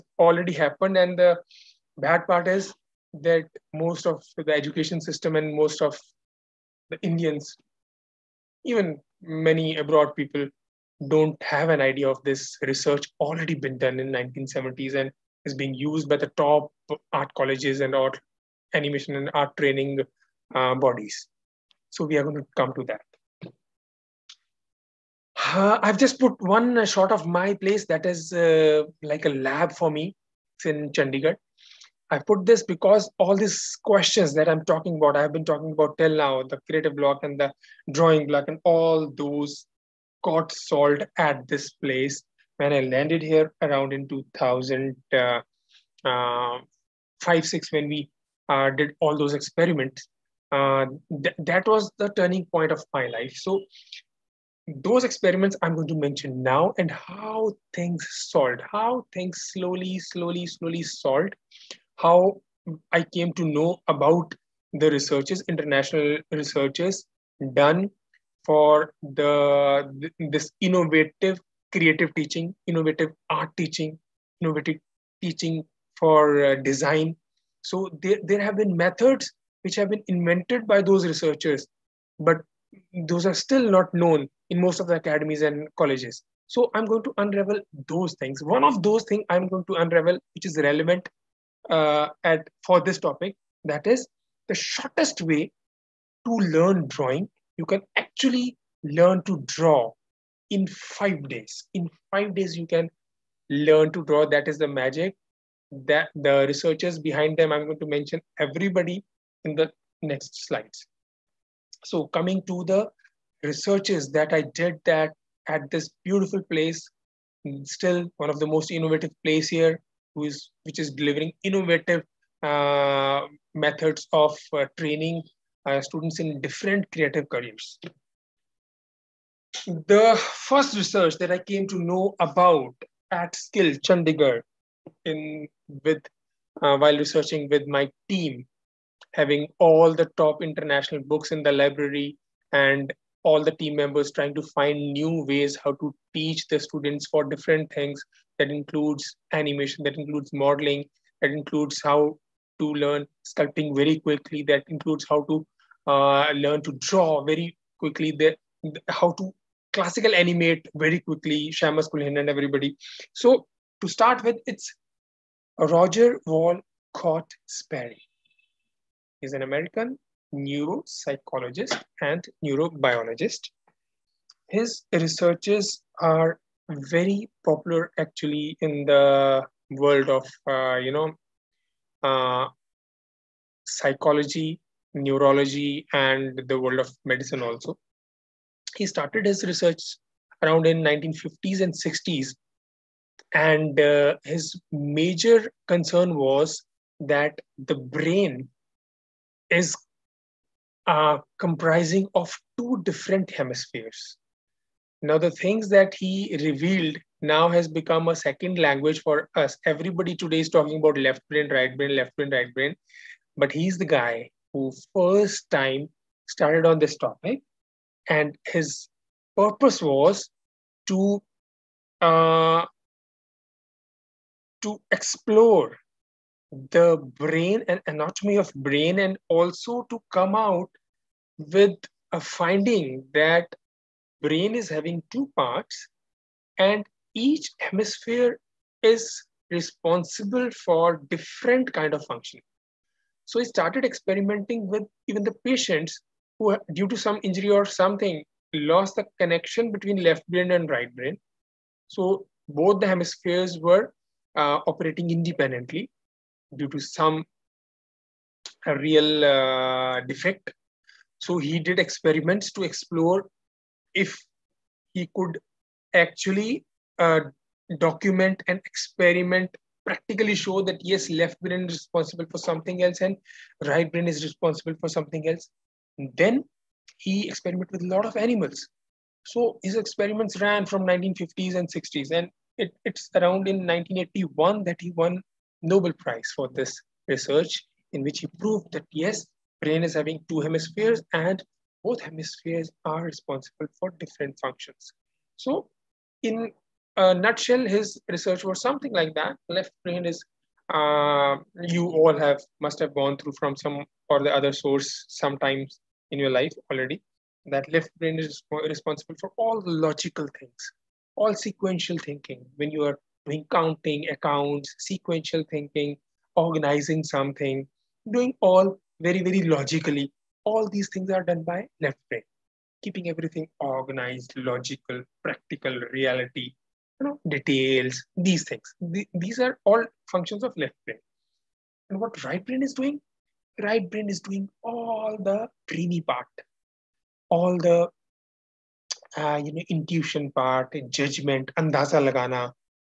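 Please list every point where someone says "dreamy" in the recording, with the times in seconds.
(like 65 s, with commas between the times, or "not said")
335 s.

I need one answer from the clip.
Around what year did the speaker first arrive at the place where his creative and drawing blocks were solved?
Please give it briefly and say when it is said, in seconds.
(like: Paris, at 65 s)
2005, at 43 s.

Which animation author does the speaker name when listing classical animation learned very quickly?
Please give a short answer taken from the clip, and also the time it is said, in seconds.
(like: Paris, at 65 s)
Shamus Culhane, at 161 s.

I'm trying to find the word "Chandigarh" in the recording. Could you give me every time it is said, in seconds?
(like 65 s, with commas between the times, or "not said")
30 s, 133 s.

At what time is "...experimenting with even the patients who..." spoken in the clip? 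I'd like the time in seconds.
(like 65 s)
243 s.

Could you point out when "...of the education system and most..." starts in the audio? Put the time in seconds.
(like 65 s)
4 s.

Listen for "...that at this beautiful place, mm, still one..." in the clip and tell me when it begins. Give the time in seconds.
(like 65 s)
114 s.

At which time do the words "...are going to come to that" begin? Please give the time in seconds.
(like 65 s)
22 s.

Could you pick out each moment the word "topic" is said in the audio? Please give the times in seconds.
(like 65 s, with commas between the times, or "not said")
92 s, 216 s.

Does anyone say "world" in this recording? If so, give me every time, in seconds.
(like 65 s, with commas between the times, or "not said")
179 s, 186 s.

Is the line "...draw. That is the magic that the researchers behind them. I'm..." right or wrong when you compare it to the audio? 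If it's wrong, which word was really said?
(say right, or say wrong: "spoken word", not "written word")
right.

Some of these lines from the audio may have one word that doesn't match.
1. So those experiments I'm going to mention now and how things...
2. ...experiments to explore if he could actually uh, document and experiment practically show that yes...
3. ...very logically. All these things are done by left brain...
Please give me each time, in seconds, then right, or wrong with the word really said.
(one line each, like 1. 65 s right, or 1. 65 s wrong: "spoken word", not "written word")
1. 53 s right
2. 261 s right
3. 319 s right.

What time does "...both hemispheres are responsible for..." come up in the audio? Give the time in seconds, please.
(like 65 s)
291 s.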